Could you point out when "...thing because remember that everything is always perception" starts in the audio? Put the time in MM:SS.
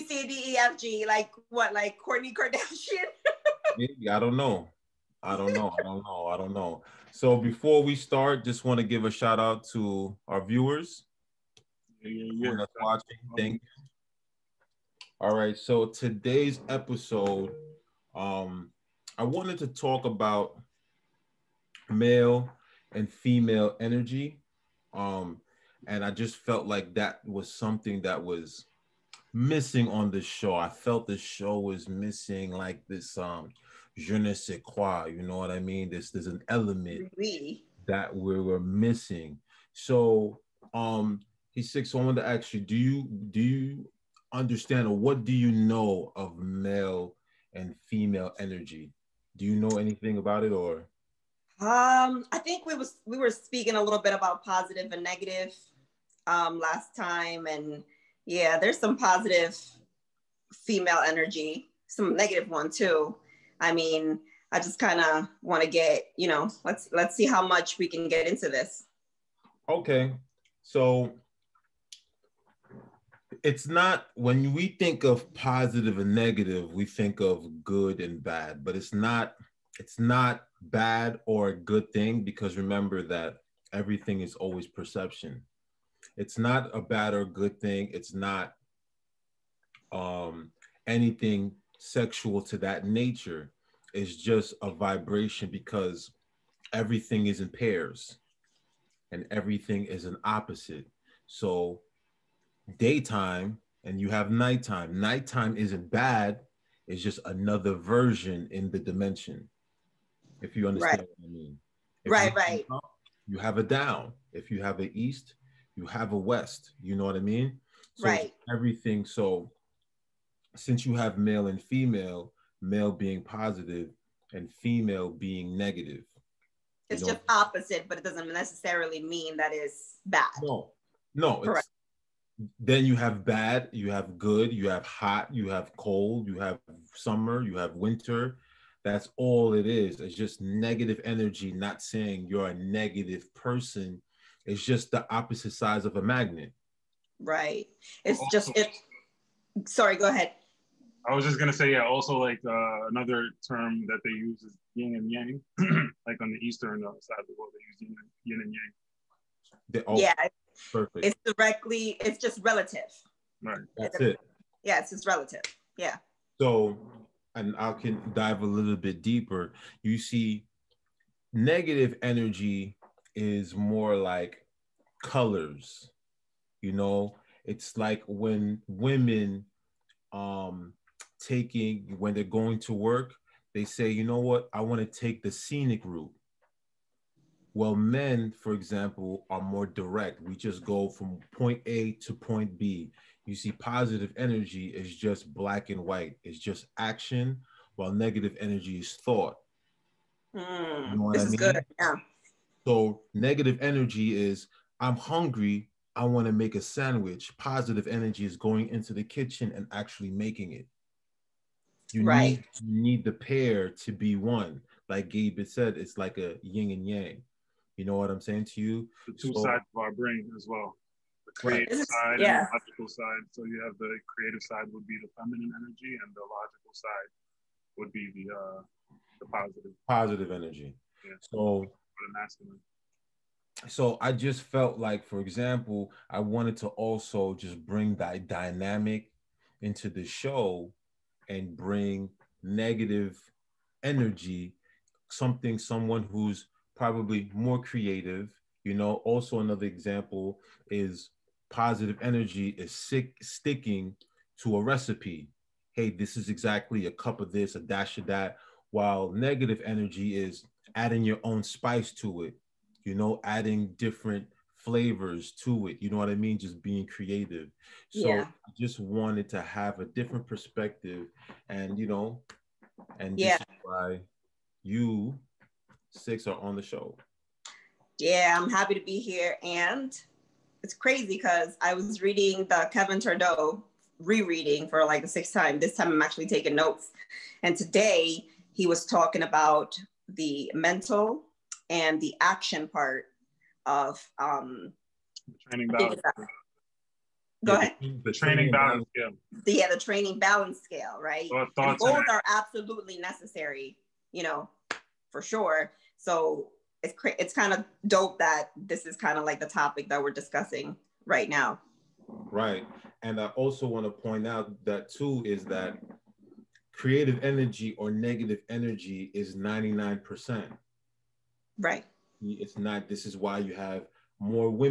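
01:21.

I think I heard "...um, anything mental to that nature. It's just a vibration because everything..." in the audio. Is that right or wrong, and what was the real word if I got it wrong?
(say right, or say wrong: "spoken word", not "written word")
wrong: "sexual", not "mental".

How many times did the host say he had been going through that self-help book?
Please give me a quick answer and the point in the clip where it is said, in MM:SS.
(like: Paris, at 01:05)
6, at 04:45.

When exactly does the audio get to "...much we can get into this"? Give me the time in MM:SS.
01:07.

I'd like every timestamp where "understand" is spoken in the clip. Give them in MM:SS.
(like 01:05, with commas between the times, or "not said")
00:44, 01:50.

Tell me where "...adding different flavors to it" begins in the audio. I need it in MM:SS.
04:23.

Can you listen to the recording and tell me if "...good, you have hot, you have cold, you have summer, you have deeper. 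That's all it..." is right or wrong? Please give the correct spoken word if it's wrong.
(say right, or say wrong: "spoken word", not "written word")
wrong: "winter", not "deeper".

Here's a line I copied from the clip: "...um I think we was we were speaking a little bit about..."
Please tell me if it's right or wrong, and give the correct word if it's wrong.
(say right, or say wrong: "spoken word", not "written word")
right.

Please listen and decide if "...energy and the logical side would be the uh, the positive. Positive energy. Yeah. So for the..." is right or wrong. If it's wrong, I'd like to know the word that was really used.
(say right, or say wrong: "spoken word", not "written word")
right.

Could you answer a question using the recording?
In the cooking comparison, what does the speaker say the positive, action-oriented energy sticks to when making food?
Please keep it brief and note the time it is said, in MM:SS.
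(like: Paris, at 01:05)
a recipe, at 04:14.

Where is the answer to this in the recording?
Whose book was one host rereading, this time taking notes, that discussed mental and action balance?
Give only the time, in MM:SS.
04:42.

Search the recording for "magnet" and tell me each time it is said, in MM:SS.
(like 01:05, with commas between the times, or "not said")
02:26.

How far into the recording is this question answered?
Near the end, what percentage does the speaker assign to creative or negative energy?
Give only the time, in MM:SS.
05:19.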